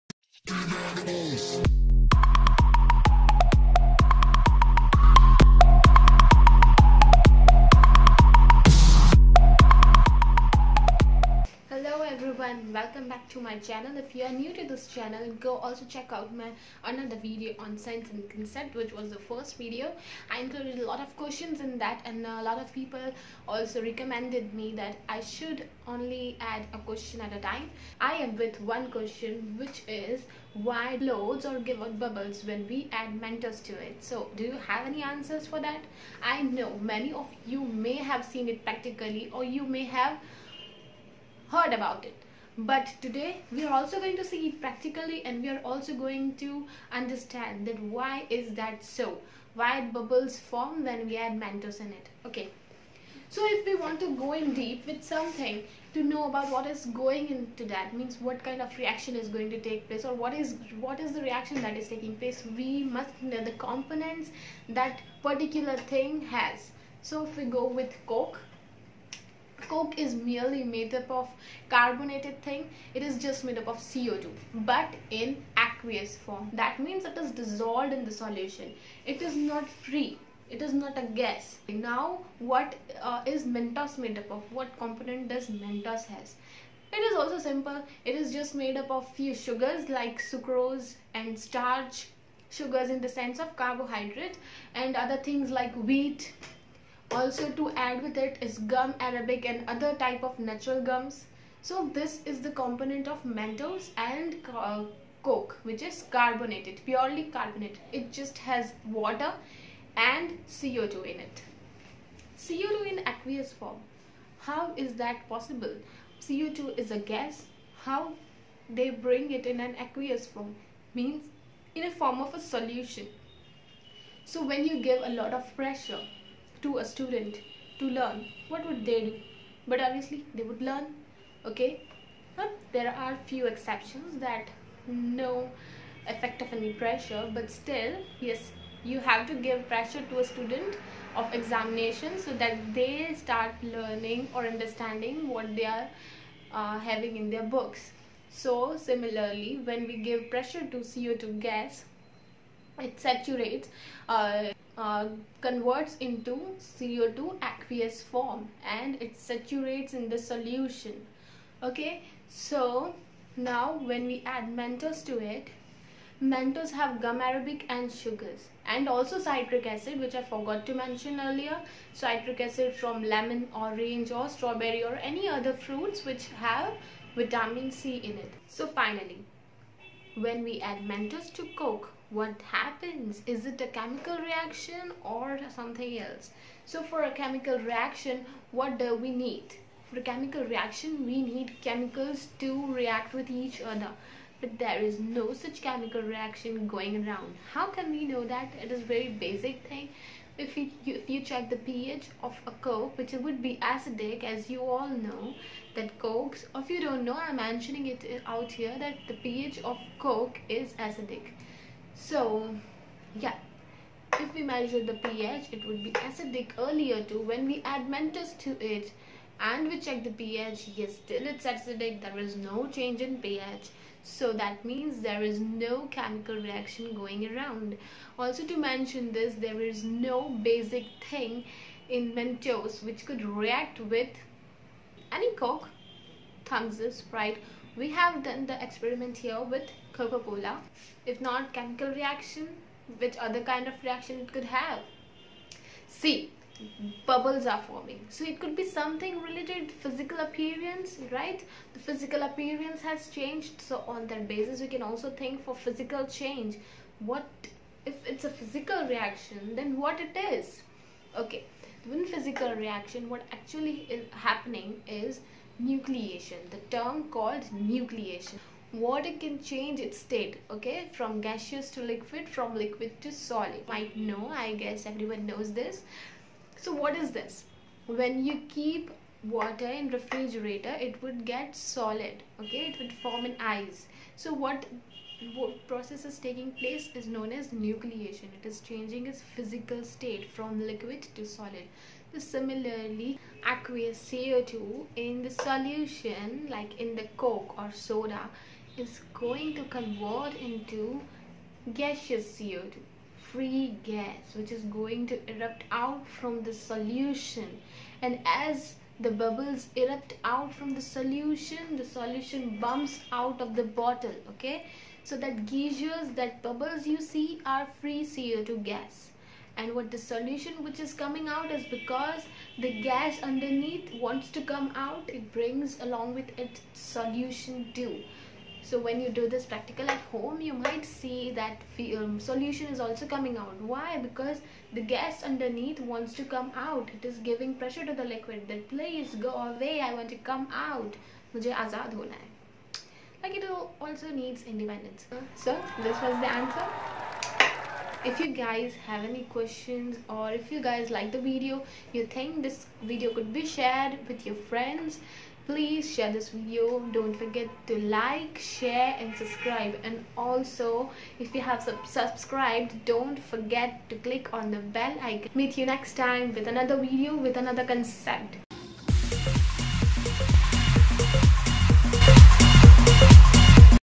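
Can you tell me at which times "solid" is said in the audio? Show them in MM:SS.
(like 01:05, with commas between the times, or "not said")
04:33, 04:41, 04:51.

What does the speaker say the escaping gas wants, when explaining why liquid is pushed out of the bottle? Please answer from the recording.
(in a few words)
independence.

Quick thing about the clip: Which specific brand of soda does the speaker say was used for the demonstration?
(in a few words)
Coca-Cola.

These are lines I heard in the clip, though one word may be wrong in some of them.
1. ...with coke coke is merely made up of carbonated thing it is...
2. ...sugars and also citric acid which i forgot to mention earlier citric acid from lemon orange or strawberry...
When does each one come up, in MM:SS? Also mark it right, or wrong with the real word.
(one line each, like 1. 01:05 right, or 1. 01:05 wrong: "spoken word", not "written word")
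1. 01:07 right
2. 02:47 right.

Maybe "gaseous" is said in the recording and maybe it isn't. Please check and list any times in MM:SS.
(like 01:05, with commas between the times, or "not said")
04:31, 05:01.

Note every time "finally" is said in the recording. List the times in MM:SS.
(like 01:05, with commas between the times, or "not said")
02:58.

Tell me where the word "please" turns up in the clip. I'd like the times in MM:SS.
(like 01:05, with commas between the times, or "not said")
05:38, 05:55.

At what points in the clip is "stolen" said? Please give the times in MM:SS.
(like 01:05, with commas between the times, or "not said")
not said.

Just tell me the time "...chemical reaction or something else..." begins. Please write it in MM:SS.
03:03.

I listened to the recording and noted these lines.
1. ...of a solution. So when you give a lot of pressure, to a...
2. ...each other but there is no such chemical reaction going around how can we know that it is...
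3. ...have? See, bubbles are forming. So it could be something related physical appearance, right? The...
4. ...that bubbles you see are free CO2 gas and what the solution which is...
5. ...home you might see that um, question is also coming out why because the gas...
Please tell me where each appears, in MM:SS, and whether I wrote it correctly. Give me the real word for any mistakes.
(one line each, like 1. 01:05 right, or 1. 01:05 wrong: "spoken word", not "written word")
1. 02:02 right
2. 03:13 right
3. 04:04 right
4. 05:16 right
5. 05:30 wrong: "solution", not "question".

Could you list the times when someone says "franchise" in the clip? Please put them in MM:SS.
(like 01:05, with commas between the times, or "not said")
not said.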